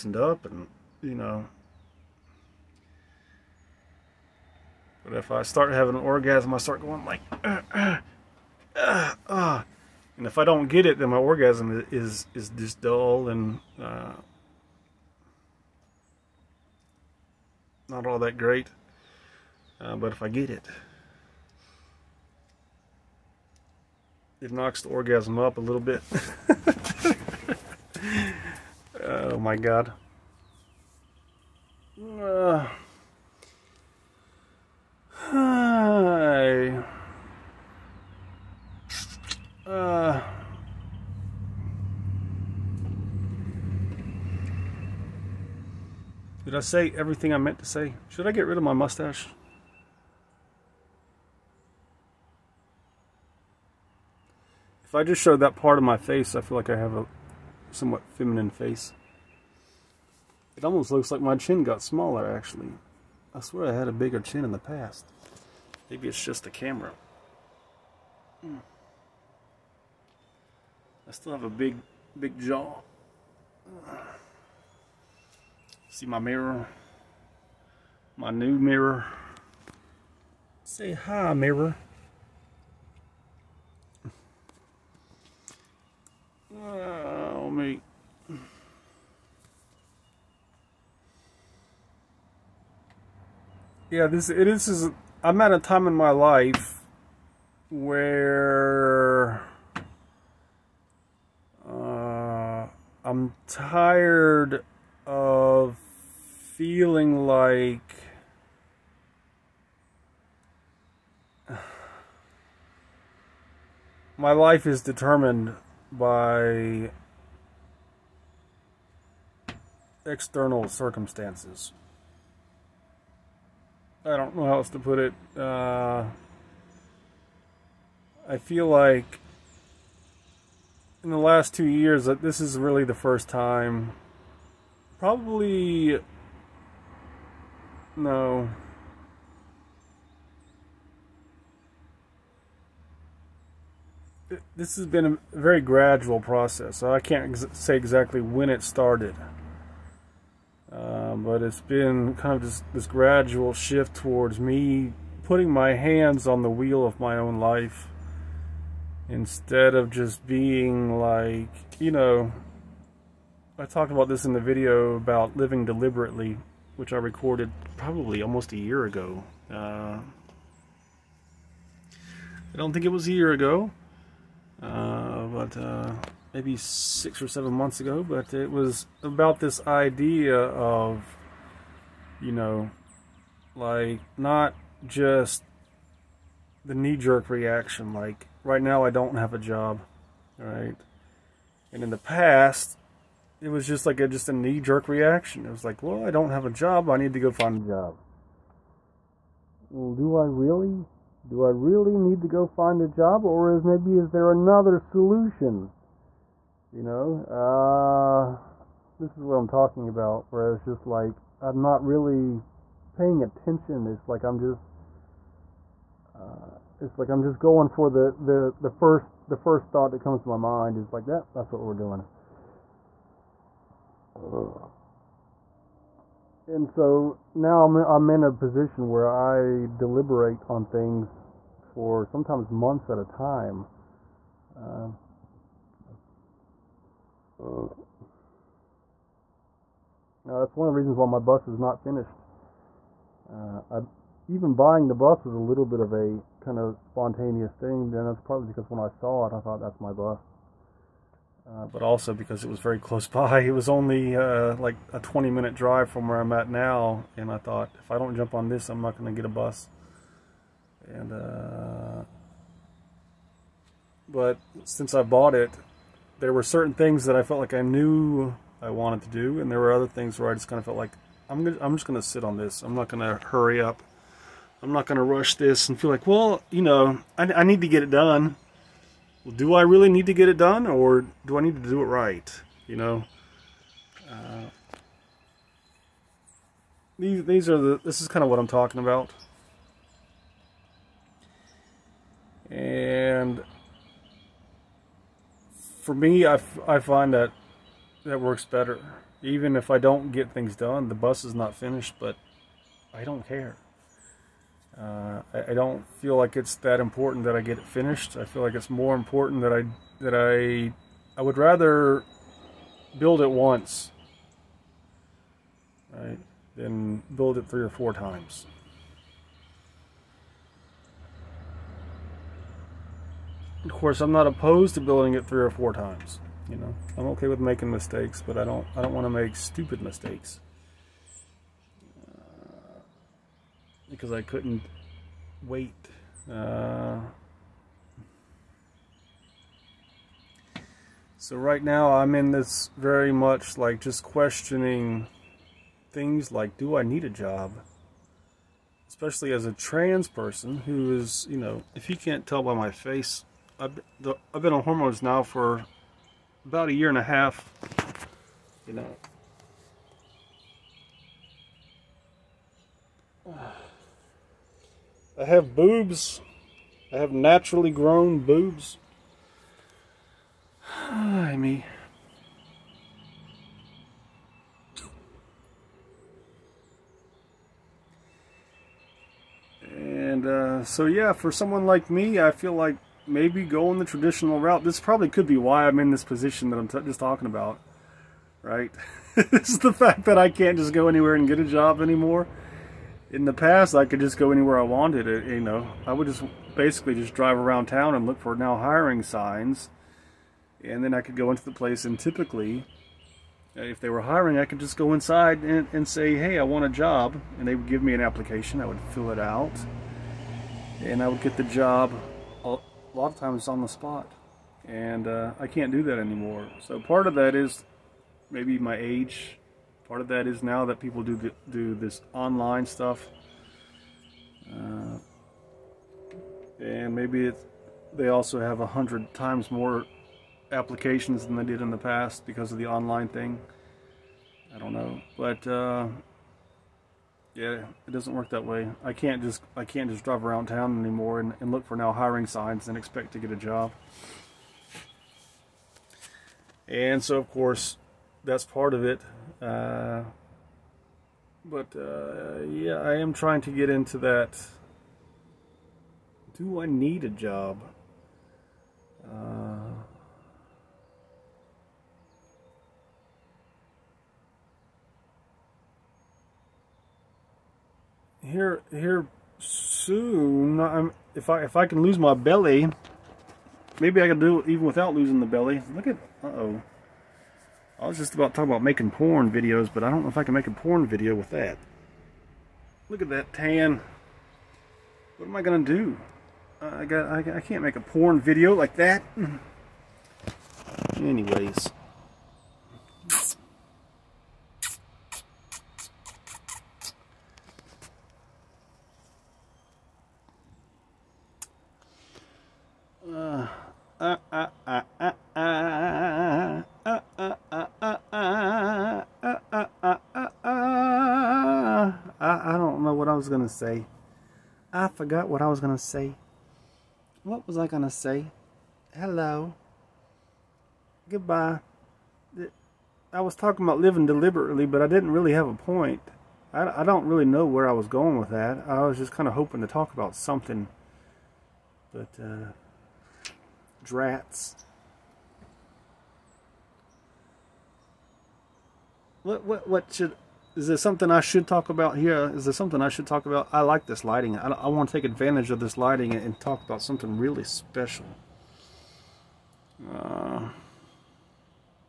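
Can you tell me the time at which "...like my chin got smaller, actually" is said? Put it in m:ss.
1:01.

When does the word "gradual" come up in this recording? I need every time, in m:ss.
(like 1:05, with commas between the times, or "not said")
2:25, 2:32.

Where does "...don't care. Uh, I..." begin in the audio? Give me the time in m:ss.
5:03.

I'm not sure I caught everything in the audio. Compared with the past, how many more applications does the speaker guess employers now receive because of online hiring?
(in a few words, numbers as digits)
100 times more.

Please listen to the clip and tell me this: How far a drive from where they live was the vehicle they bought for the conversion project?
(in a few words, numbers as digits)
20 minutes.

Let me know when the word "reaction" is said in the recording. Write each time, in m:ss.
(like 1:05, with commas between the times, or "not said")
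3:07, 3:14.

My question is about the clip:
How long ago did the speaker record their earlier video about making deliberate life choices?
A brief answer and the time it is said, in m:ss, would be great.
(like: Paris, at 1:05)
6 or 7 months, at 2:56.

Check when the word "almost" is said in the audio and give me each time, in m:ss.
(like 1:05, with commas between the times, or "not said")
1:00, 2:48.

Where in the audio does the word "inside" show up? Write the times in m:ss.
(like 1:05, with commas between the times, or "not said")
6:44.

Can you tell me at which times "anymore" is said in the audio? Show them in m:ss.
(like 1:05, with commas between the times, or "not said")
6:31, 6:55, 7:20.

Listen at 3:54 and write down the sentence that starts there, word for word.
Uh, uh, that's one of the reasons why my bus is not finished.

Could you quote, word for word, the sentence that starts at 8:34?
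I forgot what I was going to say.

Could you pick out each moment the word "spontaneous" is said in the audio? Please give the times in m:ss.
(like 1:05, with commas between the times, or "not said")
4:06.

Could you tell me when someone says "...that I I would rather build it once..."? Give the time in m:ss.
5:10.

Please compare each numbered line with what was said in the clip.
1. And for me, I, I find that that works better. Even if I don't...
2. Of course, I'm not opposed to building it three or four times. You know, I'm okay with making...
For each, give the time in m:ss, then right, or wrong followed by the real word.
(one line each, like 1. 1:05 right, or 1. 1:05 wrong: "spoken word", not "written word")
1. 4:52 right
2. 5:23 right.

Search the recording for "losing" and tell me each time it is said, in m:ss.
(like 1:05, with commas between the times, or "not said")
7:54.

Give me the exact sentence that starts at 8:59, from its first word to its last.
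What, what, what should is there something I should talk about here?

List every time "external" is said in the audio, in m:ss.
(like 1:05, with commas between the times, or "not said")
2:00.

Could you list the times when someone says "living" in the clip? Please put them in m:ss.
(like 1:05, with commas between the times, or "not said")
2:45, 8:43.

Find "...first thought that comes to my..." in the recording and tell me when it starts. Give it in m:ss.
3:39.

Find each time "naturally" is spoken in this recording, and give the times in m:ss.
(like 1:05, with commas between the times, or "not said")
6:07.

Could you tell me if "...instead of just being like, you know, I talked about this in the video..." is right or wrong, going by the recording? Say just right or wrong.
right.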